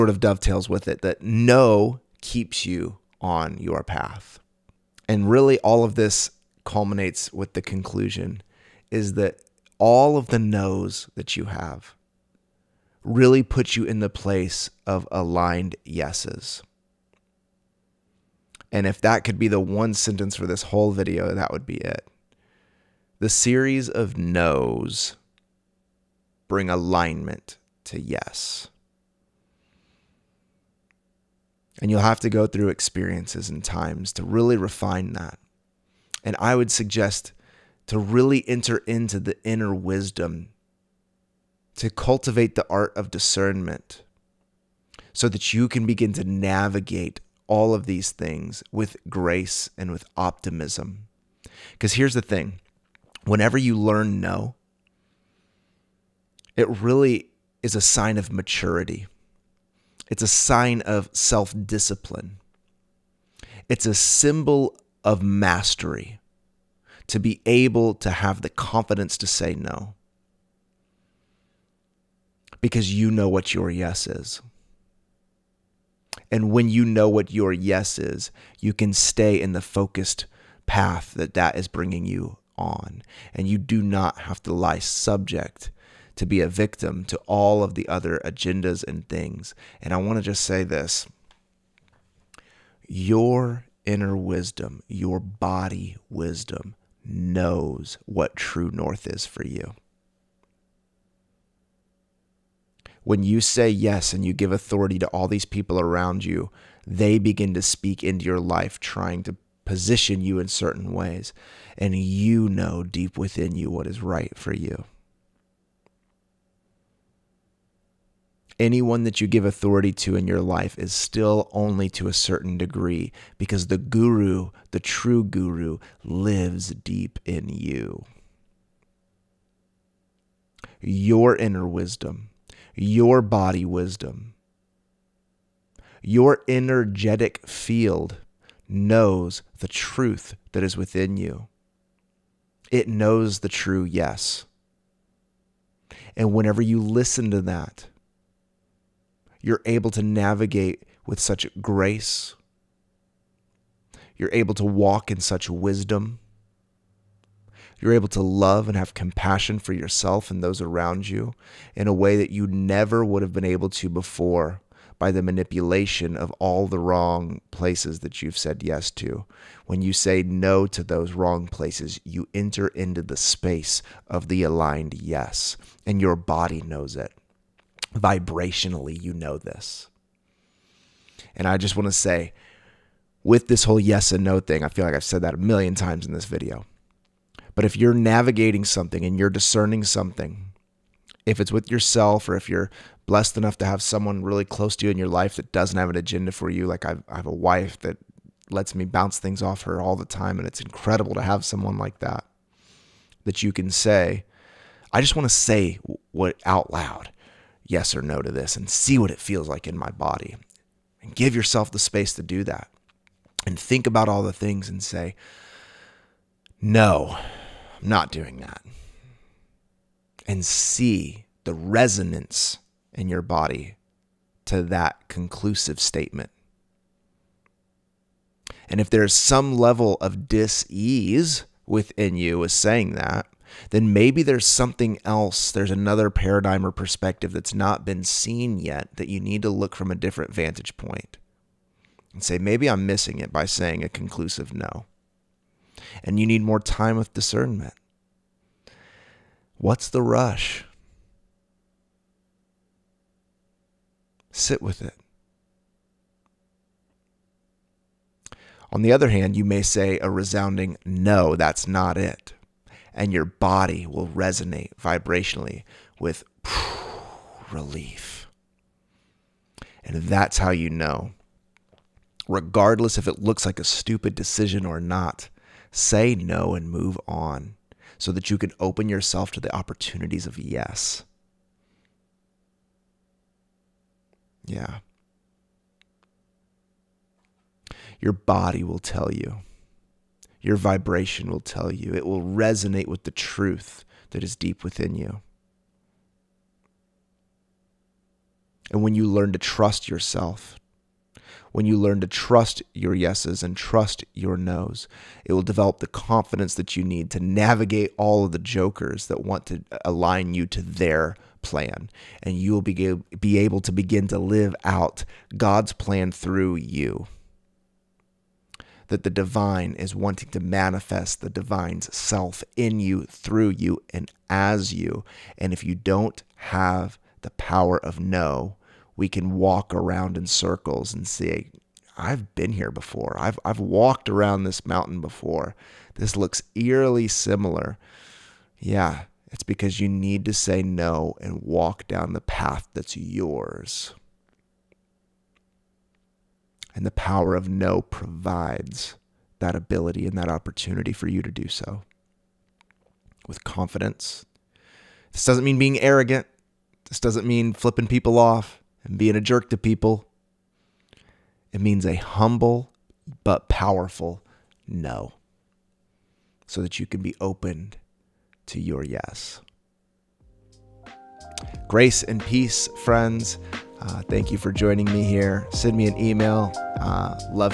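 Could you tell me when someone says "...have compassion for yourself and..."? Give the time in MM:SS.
02:38.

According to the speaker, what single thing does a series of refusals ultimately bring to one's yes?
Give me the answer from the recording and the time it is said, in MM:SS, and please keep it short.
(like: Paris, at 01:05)
Alignment, at 00:26.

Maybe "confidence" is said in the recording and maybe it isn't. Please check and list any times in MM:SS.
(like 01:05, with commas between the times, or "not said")
01:08, 05:05, 05:53.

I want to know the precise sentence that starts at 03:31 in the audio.
And give yourself the space to do that.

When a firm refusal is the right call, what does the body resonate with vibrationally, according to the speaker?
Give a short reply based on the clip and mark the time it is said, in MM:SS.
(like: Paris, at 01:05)
Relief, at 04:27.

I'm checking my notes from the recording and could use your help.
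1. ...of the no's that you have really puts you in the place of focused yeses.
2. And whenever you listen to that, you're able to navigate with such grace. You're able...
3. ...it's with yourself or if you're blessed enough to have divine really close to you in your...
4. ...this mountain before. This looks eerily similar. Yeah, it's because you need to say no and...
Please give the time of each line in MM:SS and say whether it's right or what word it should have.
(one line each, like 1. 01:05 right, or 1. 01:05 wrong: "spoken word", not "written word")
1. 00:10 wrong: "aligned", not "focused"
2. 02:26 right
3. 03:11 wrong: "someone", not "divine"
4. 05:34 right.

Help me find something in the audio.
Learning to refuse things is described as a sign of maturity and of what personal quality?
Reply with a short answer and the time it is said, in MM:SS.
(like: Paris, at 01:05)
Self discipline, at 01:01.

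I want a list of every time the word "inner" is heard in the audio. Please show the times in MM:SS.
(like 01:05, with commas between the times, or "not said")
00:39, 01:33, 02:11.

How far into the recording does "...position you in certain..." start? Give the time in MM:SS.
01:49.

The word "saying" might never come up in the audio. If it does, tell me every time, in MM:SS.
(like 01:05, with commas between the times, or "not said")
03:52, 04:03.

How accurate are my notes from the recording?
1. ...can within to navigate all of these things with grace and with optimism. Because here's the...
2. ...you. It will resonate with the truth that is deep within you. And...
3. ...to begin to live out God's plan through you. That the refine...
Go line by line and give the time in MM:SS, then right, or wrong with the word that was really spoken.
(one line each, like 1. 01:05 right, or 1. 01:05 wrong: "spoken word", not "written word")
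1. 00:45 wrong: "begin", not "within"
2. 04:51 right
3. 05:13 wrong: "divine", not "refine".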